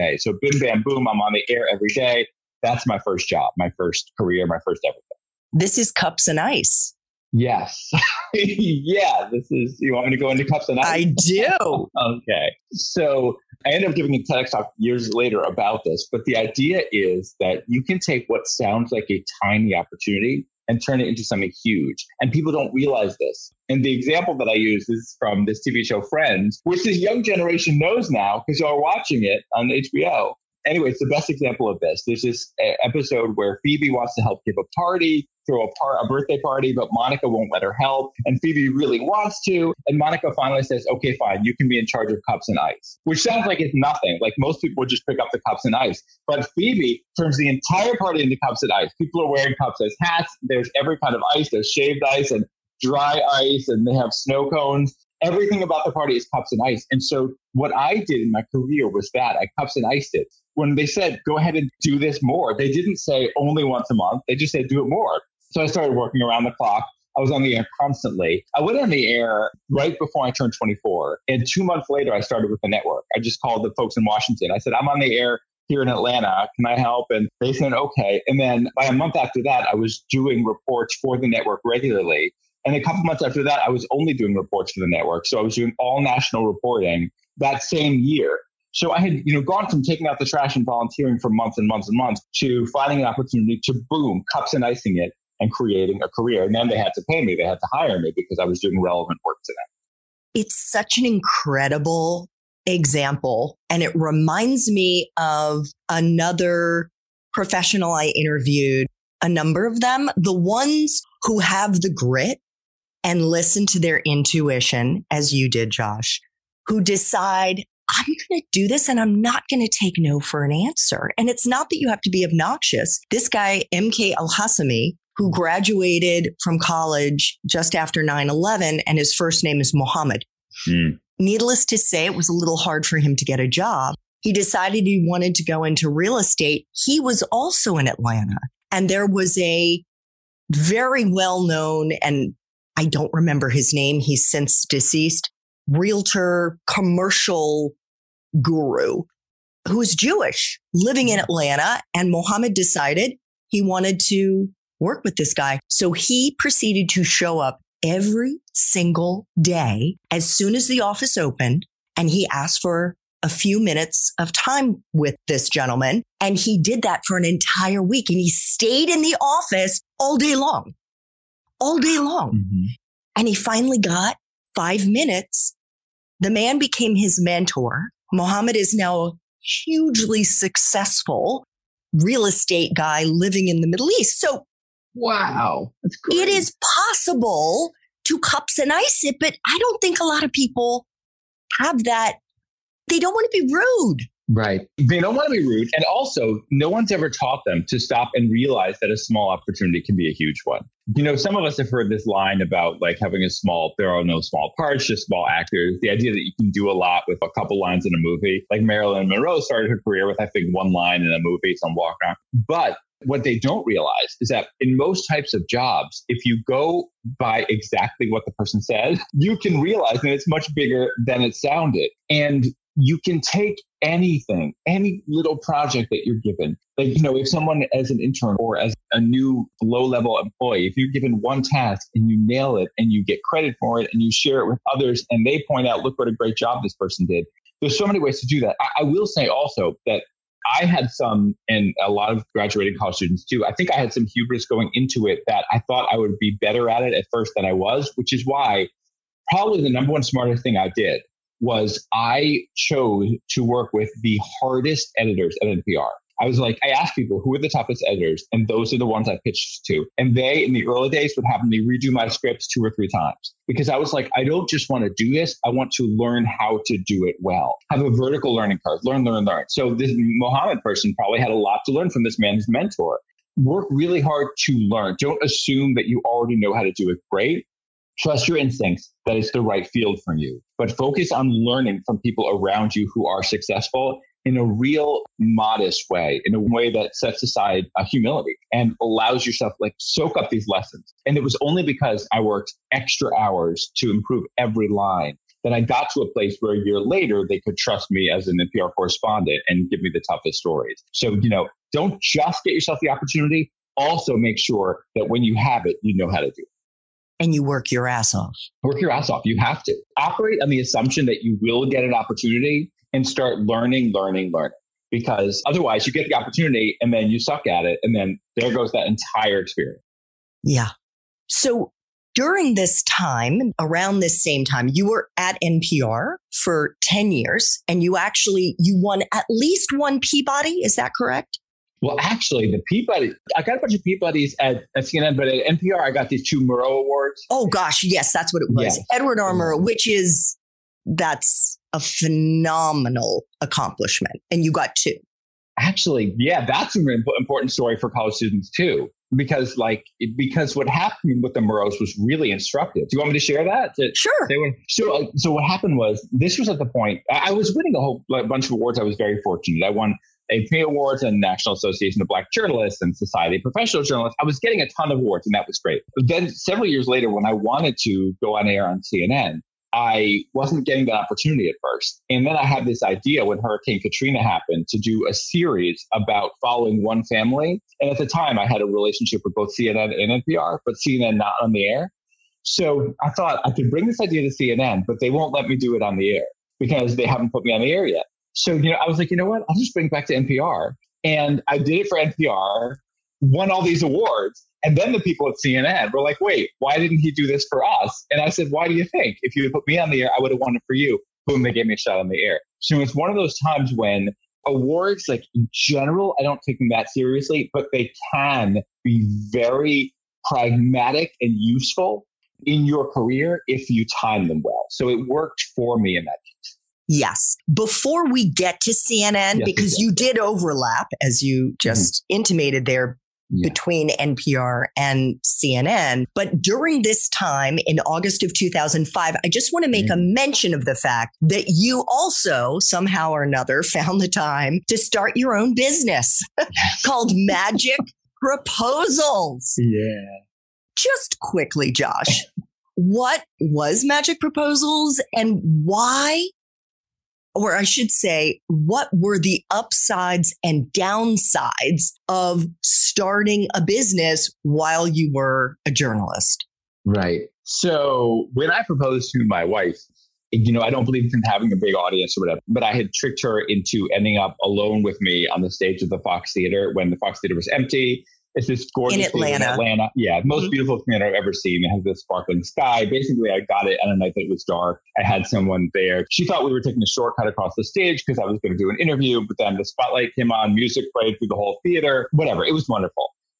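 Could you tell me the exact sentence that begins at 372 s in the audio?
And then I had this idea when Hurricane Katrina happened to do a series about following one family.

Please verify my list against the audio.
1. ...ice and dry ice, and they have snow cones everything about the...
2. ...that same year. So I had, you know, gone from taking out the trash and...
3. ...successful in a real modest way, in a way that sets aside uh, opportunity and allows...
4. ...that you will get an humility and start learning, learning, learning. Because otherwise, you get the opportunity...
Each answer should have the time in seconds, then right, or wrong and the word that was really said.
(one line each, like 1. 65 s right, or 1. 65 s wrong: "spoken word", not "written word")
1. 52 s right
2. 87 s right
3. 283 s wrong: "humility", not "opportunity"
4. 311 s wrong: "opportunity", not "humility".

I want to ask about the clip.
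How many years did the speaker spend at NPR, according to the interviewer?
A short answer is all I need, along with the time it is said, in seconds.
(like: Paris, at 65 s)
10, at 326 s.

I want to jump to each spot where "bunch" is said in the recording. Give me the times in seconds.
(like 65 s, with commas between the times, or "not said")
333 s, 358 s.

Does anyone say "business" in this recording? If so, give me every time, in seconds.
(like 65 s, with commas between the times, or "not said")
435 s, 453 s.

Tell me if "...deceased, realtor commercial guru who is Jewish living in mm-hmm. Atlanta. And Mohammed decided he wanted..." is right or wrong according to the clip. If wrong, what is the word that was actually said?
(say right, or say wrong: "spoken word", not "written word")
right.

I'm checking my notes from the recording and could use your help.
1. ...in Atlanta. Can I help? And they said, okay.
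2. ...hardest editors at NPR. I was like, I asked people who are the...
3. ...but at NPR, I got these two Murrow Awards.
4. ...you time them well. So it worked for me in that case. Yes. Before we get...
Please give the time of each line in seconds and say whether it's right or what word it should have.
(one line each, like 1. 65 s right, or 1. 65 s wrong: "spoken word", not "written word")
1. 75 s right
2. 254 s right
3. 335 s right
4. 413 s right.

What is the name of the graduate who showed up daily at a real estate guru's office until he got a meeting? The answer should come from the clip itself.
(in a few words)
MK Al Hassami.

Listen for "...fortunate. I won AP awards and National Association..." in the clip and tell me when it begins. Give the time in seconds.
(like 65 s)
359 s.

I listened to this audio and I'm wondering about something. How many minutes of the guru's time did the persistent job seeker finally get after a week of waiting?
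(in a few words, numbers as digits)
5.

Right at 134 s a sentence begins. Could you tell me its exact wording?
He decided he wanted to go into real estate.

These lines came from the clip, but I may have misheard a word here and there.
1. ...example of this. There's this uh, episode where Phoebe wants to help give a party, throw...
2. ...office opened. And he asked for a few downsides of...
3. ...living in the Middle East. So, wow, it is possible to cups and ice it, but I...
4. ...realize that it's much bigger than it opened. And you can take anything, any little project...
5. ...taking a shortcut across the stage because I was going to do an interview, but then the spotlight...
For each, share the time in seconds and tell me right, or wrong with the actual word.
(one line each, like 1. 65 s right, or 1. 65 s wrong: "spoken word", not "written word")
1. 31 s right
2. 160 s wrong: "minutes", not "downsides"
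3. 183 s right
4. 219 s wrong: "sounded", not "opened"
5. 476 s right.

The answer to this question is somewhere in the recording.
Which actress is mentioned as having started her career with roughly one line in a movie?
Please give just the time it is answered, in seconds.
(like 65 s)
208 s.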